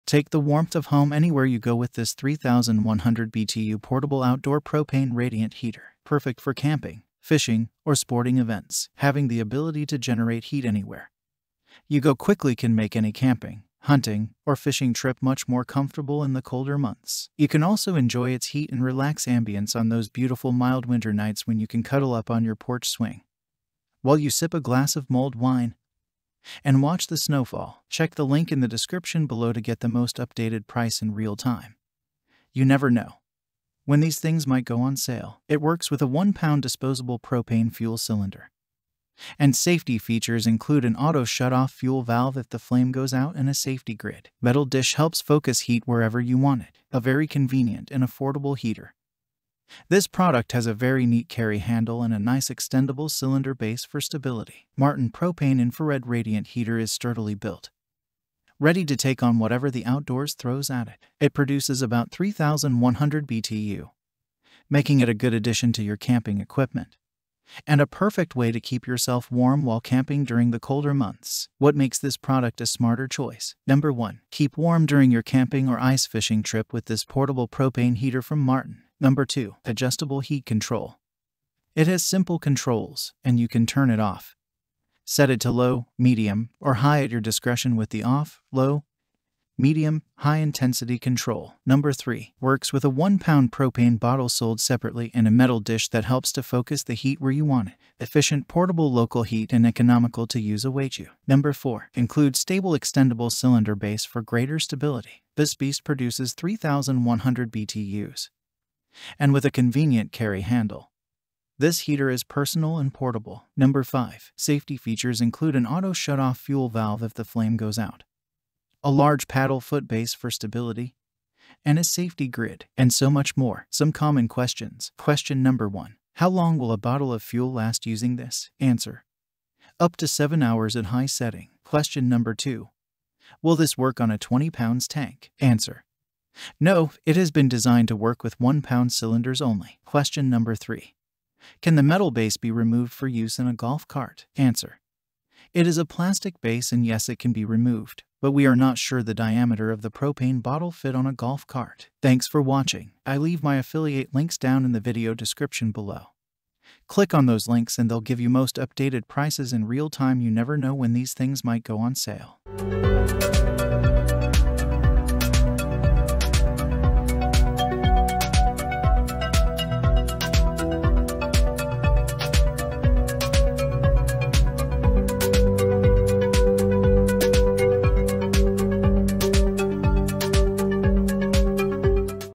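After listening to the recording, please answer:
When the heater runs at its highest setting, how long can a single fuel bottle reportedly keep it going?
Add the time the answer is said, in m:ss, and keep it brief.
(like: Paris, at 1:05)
7 hours, at 2:10.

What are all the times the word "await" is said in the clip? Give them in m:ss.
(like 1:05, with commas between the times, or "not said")
1:40.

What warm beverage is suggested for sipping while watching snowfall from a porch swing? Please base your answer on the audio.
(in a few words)
Mulled wine.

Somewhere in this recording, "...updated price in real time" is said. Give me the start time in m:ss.
0:30.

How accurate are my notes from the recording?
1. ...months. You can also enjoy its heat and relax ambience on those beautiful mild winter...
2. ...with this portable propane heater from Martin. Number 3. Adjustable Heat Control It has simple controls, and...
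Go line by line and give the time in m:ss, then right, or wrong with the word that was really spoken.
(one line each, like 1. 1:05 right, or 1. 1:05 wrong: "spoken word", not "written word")
1. 0:16 right
2. 1:16 wrong: "2", not "3".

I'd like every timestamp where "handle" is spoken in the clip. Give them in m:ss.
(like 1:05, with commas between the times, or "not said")
0:51, 1:50.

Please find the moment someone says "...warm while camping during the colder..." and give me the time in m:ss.
1:09.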